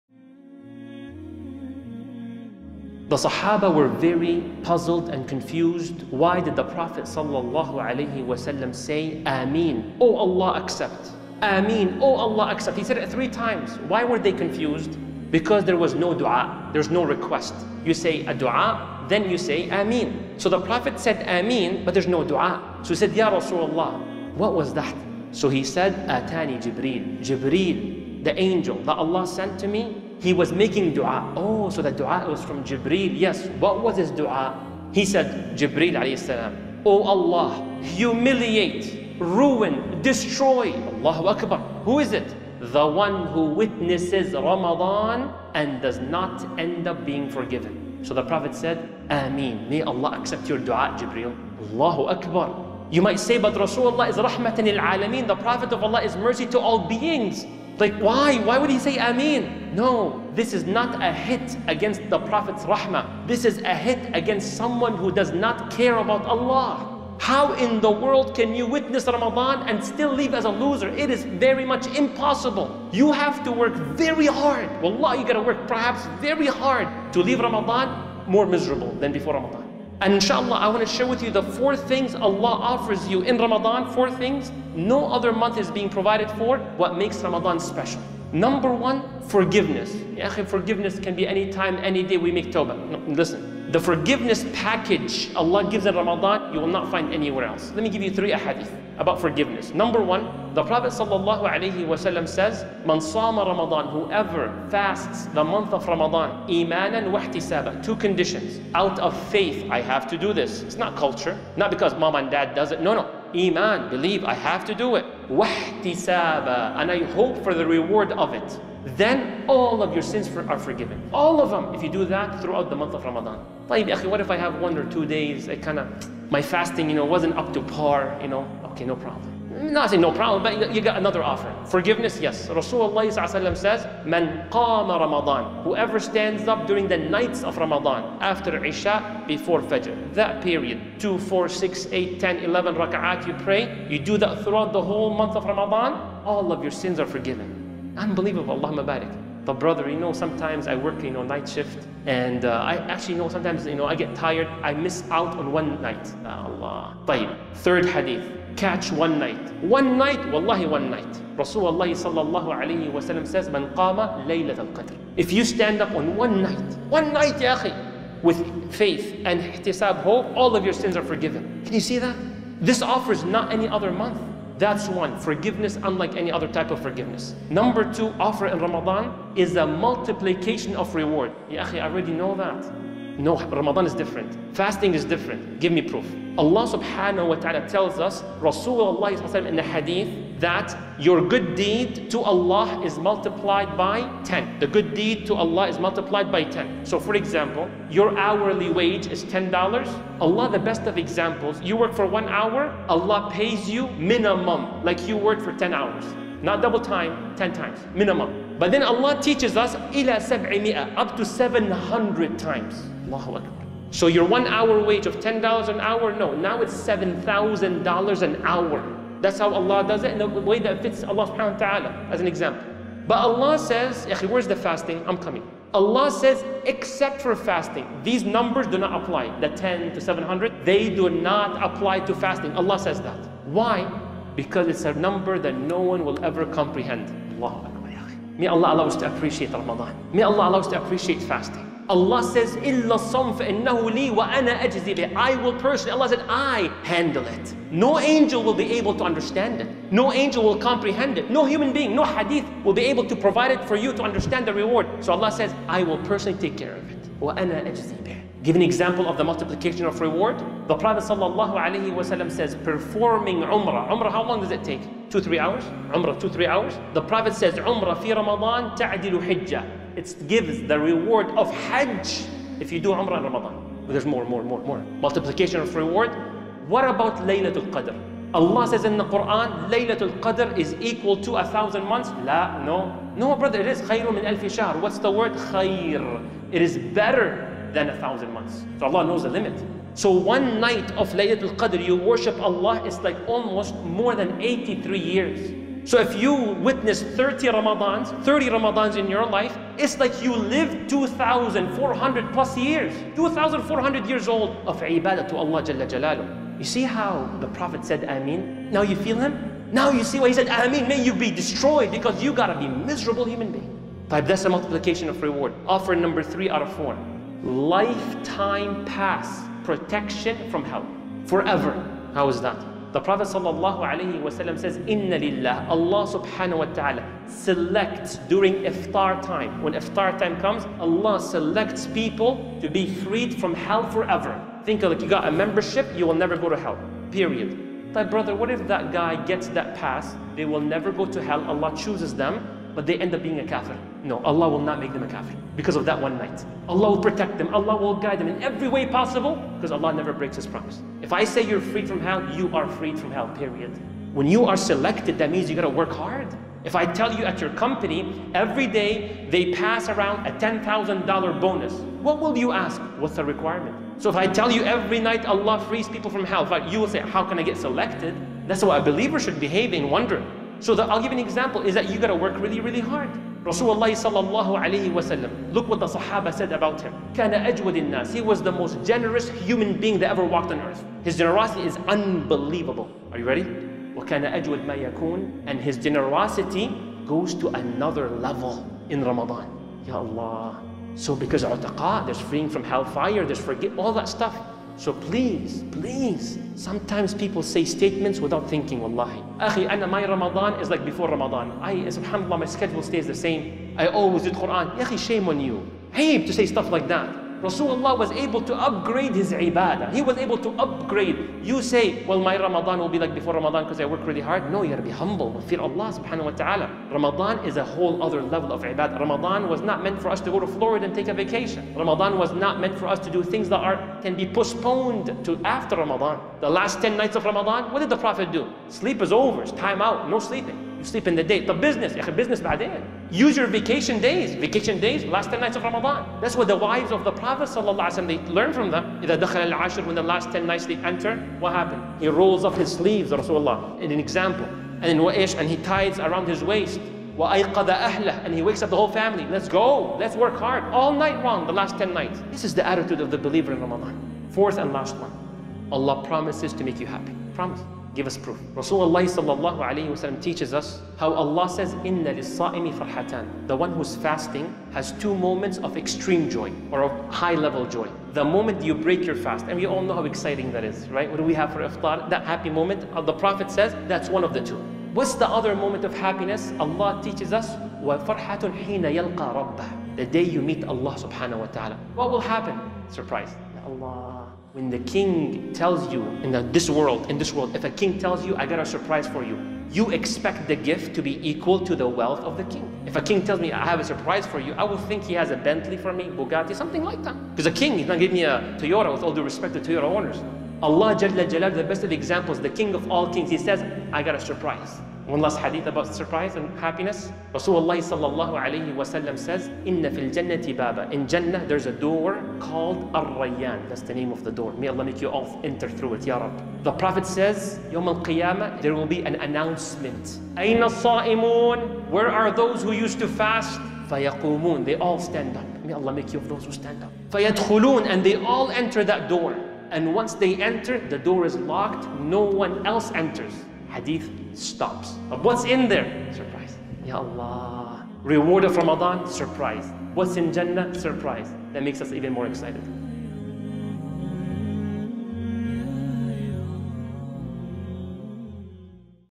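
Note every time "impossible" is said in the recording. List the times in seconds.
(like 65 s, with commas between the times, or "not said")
71 s.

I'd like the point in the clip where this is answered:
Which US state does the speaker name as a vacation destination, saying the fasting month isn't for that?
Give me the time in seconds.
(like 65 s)
420 s.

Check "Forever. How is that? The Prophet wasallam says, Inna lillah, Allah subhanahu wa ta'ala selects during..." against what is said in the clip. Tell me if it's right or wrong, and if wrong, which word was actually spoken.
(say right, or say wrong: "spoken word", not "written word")
right.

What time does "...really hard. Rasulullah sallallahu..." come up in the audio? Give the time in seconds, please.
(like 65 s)
372 s.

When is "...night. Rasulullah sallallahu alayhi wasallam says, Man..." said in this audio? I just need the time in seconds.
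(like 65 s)
160 s.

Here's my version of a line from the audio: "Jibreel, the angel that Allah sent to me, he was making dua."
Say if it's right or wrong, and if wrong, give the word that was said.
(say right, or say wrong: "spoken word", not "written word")
right.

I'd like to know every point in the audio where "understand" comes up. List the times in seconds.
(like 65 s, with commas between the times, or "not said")
249 s, 254 s.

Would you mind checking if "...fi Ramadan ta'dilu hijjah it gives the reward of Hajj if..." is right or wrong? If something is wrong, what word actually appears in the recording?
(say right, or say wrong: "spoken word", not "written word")
right.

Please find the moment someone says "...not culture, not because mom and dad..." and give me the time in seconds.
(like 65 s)
110 s.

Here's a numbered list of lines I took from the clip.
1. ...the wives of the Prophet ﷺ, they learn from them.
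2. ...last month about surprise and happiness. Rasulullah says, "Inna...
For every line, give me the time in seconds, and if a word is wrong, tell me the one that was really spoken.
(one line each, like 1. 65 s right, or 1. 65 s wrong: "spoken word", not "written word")
1. 436 s right
2. 505 s wrong: "hadith", not "month".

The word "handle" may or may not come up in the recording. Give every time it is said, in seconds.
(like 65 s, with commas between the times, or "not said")
246 s.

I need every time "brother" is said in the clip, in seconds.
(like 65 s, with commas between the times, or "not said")
149 s, 283 s, 338 s.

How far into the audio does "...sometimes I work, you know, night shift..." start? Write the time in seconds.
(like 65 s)
150 s.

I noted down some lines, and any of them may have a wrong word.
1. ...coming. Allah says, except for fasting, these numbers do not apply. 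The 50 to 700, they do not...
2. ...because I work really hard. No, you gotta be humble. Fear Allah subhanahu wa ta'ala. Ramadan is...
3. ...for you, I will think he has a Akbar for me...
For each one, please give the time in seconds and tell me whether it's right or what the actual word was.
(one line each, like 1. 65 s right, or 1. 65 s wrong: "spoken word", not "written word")
1. 225 s wrong: "10", not "50"
2. 413 s right
3. 494 s wrong: "Bentley", not "Akbar".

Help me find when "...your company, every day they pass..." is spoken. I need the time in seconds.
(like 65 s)
357 s.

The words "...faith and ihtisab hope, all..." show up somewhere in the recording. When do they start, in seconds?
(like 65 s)
168 s.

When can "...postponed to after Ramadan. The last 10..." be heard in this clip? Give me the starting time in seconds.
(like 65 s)
424 s.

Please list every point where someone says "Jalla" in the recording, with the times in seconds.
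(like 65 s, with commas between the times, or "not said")
305 s, 500 s.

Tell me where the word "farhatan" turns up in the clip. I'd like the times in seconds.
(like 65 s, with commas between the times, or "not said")
462 s.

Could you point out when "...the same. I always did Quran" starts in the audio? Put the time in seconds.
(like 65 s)
403 s.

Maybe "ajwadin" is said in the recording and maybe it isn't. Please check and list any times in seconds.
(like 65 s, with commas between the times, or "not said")
377 s.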